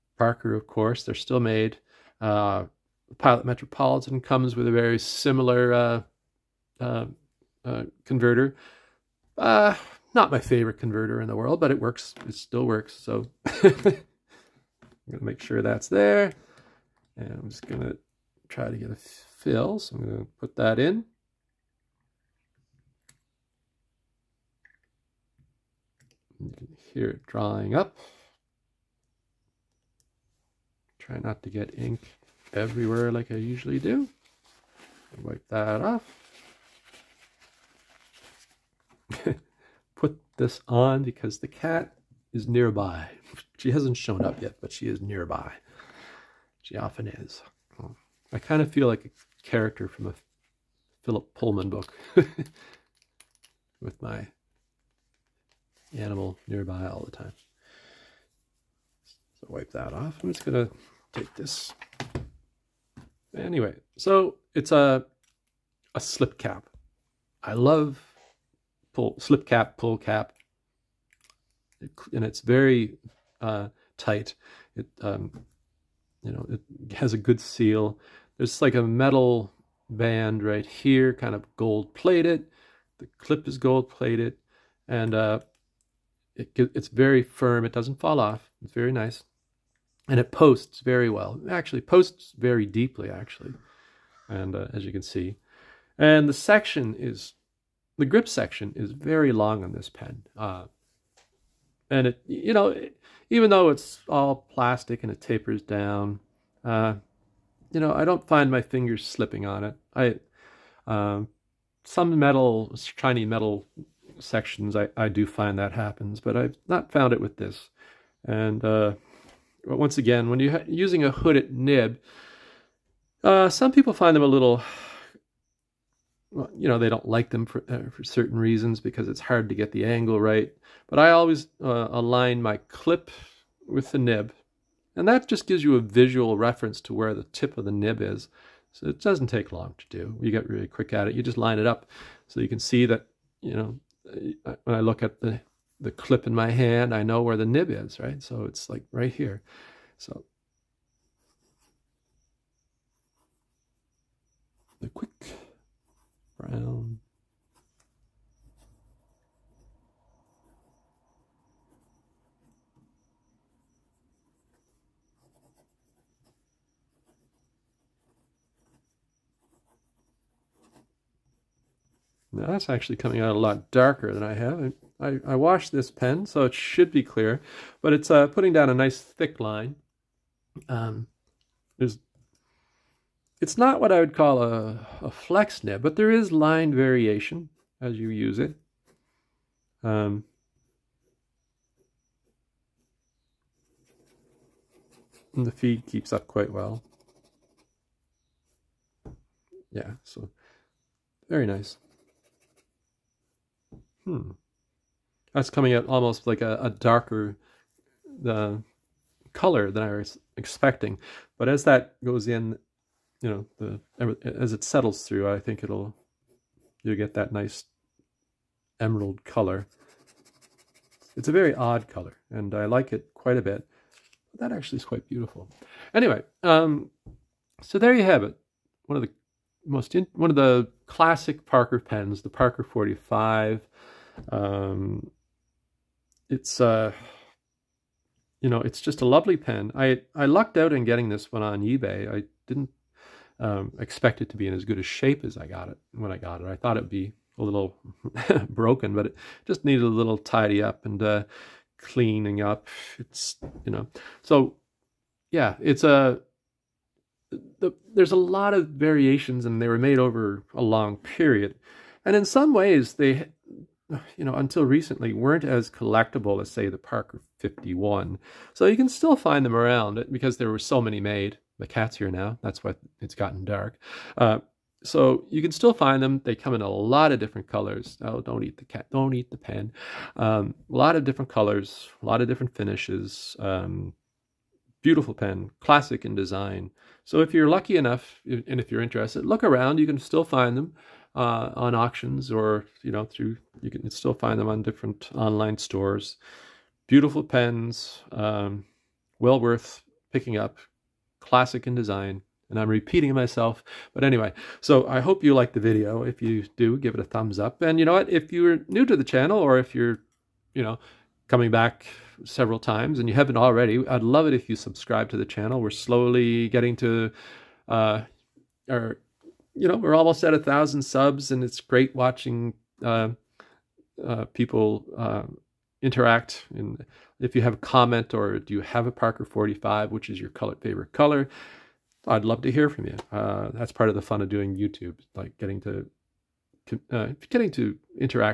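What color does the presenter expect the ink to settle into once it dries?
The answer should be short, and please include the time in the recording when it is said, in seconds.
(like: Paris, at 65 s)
Emerald, at 218 s.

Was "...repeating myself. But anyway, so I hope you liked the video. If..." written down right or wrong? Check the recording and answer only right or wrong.
right.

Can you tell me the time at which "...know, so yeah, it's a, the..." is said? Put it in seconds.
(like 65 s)
253 s.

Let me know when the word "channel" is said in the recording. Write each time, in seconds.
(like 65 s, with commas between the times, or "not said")
309 s, 315 s.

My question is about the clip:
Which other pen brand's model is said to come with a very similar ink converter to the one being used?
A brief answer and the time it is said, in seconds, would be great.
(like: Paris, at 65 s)
Pilot Metropolitan, at 3 s.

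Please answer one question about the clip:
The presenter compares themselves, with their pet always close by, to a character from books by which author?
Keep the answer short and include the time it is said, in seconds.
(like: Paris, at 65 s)
Philip Pullman, at 51 s.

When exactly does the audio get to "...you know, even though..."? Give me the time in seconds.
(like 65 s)
102 s.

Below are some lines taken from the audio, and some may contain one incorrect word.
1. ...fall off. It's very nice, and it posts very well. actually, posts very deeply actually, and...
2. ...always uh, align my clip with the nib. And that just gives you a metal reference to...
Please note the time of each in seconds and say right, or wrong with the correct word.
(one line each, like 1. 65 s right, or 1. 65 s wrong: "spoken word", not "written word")
1. 87 s right
2. 131 s wrong: "visual", not "metal".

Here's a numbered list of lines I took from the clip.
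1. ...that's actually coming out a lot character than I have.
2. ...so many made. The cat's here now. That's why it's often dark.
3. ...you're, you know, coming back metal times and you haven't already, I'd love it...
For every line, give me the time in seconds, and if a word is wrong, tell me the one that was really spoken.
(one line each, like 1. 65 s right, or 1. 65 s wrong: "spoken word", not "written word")
1. 172 s wrong: "darker", not "character"
2. 270 s wrong: "gotten", not "often"
3. 309 s wrong: "several", not "metal".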